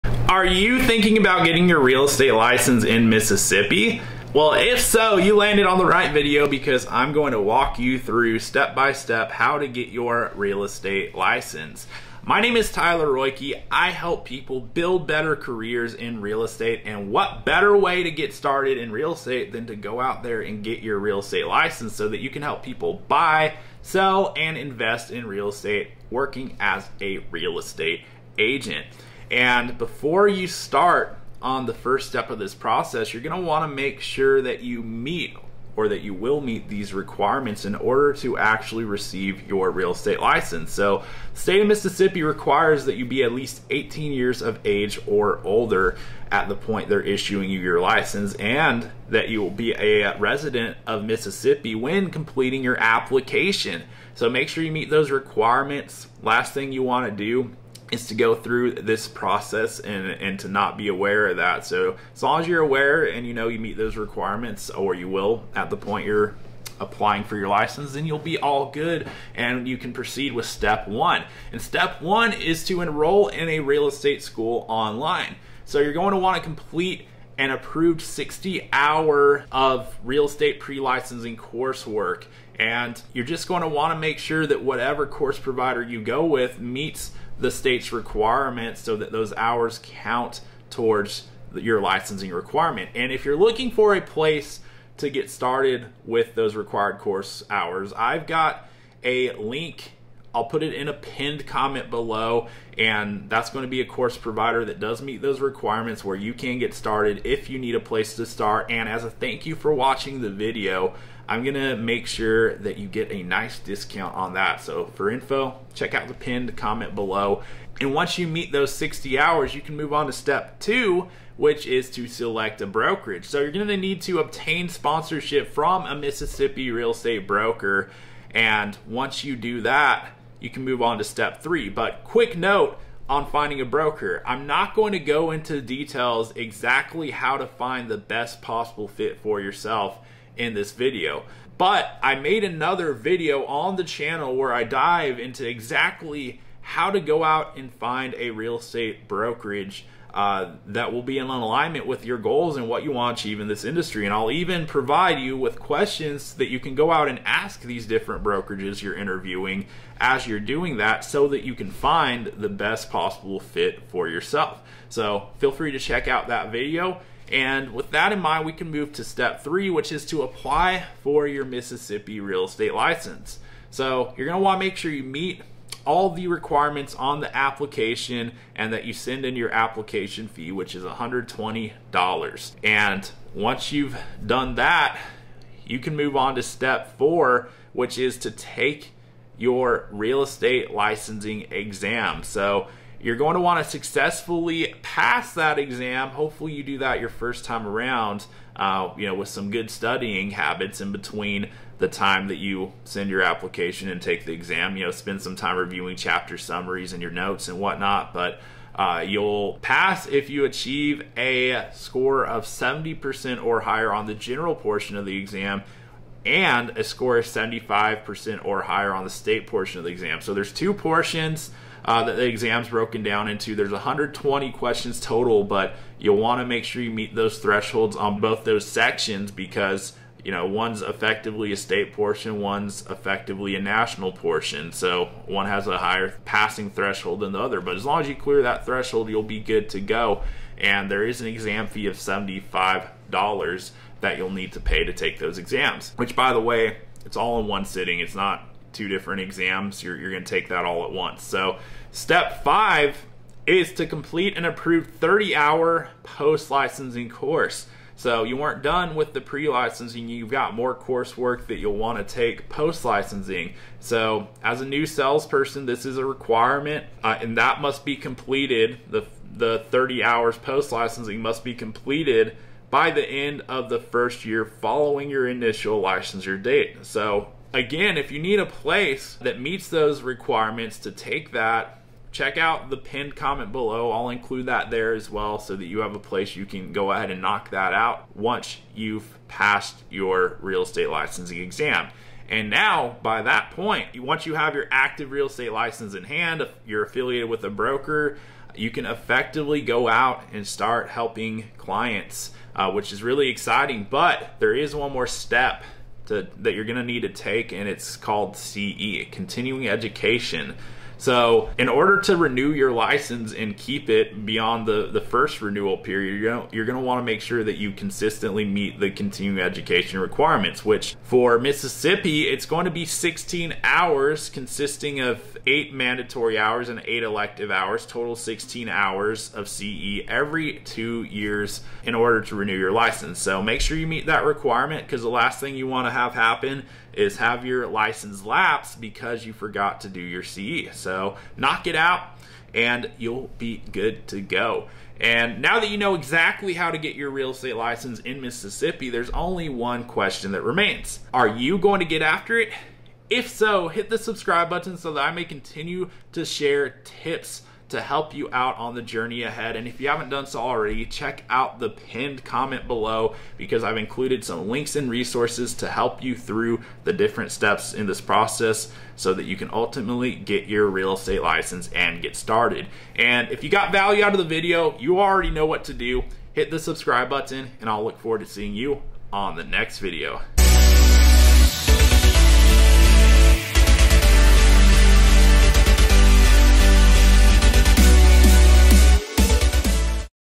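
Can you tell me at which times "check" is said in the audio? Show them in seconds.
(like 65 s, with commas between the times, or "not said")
115 s, 165 s, 282 s, 360 s.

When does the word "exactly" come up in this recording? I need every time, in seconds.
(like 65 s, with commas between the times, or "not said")
136 s, 145 s, 345 s.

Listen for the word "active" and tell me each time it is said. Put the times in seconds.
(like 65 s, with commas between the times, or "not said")
294 s.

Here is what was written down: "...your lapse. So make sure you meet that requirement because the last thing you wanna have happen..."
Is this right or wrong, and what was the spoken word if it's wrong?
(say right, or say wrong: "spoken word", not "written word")
wrong: "license", not "lapse".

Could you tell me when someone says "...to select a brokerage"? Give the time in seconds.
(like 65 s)
121 s.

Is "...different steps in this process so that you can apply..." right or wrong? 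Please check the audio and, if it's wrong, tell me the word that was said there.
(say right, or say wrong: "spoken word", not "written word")
wrong: "ultimately", not "apply".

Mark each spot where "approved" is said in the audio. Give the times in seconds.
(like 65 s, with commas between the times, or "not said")
77 s, 254 s.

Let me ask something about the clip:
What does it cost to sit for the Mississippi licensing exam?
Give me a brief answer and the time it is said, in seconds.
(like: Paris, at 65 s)
$75, at 241 s.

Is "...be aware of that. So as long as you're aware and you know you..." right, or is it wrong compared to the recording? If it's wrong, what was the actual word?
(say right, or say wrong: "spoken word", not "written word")
right.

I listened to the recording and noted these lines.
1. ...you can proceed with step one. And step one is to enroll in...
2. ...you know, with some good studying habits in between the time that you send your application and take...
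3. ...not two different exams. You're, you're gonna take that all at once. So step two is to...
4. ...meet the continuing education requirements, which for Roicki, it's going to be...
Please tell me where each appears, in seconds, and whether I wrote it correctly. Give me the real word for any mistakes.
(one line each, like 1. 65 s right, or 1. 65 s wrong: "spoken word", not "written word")
1. 69 s right
2. 198 s right
3. 248 s wrong: "five", not "two"
4. 318 s wrong: "Mississippi", not "Roicki".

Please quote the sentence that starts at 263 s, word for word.
So as a new salesperson, this is a requirement uh, and that must be completed.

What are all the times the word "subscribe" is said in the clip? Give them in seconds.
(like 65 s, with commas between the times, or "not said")
353 s, 376 s.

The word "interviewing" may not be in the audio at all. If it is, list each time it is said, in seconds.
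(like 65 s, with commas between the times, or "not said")
158 s.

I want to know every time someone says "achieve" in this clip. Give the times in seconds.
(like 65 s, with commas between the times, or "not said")
153 s, 210 s.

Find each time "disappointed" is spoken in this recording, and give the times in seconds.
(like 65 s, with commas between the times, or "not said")
not said.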